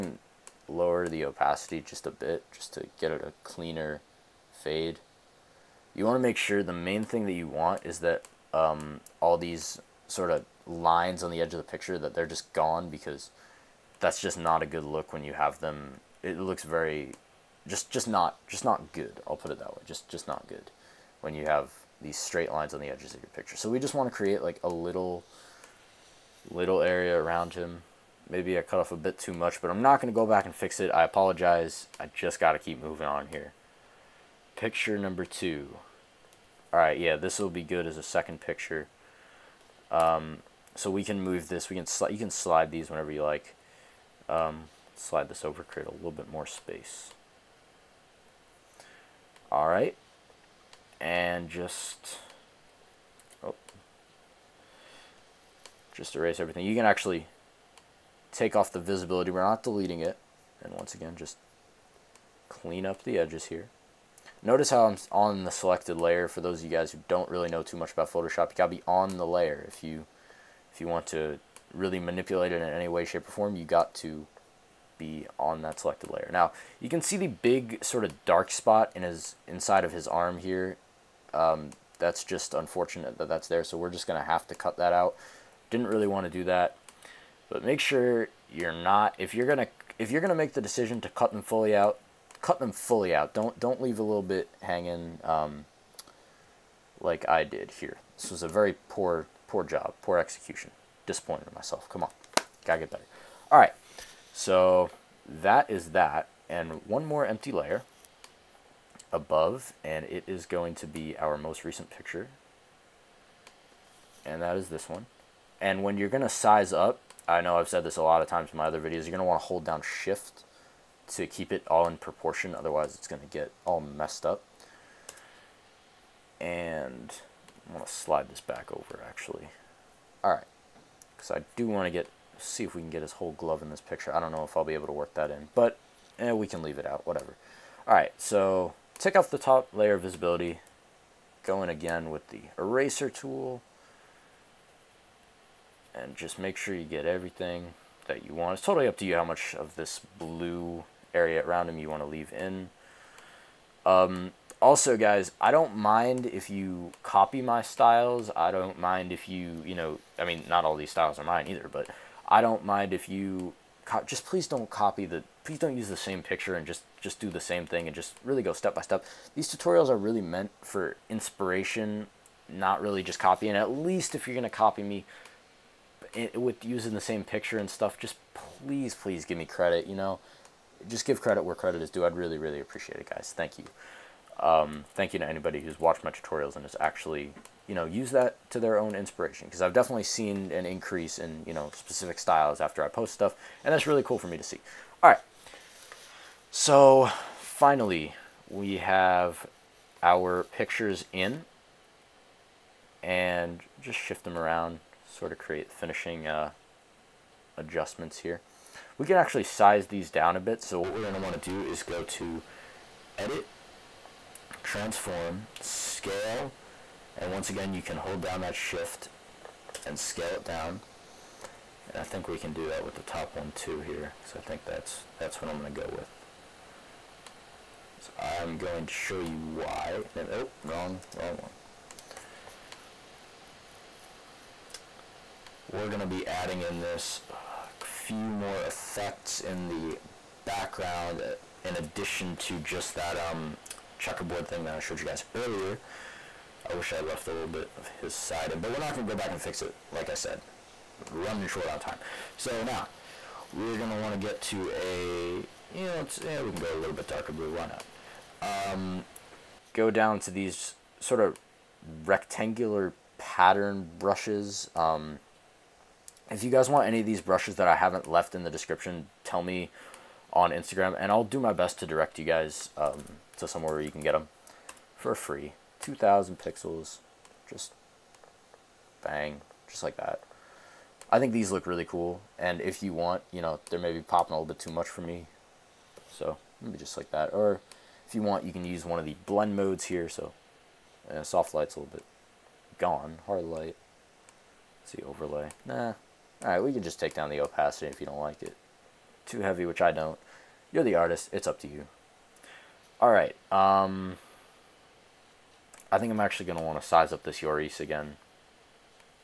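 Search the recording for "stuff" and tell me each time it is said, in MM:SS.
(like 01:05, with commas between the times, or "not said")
02:57, 03:13.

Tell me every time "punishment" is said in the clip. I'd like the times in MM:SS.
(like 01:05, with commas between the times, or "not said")
not said.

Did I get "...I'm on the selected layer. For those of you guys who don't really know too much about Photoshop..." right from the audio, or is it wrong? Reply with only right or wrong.
right.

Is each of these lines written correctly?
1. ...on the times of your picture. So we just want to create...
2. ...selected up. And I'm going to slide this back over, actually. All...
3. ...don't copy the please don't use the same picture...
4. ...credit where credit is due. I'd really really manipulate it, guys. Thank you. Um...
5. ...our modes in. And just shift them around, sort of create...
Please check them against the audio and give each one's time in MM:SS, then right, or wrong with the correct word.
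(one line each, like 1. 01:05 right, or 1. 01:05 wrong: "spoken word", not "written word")
1. 00:22 wrong: "edges", not "times"
2. 02:03 wrong: "messed", not "selected"
3. 02:44 right
4. 03:01 wrong: "appreciate", not "manipulate"
5. 03:20 wrong: "pictures", not "modes".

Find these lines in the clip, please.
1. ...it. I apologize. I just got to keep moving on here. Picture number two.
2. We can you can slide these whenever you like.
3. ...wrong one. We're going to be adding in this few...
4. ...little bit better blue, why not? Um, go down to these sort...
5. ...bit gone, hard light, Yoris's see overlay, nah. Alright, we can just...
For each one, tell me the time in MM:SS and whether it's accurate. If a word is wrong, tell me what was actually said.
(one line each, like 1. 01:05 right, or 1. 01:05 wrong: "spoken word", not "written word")
1. 00:30 right
2. 00:41 right
3. 03:51 right
4. 04:16 wrong: "darker", not "better"
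5. 04:51 wrong: "Let", not "Yoris".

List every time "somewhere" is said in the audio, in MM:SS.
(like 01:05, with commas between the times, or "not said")
04:33.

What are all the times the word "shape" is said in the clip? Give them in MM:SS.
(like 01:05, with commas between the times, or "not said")
01:13.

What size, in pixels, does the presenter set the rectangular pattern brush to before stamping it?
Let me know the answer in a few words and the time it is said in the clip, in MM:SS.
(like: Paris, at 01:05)
2,000 pixels, at 04:35.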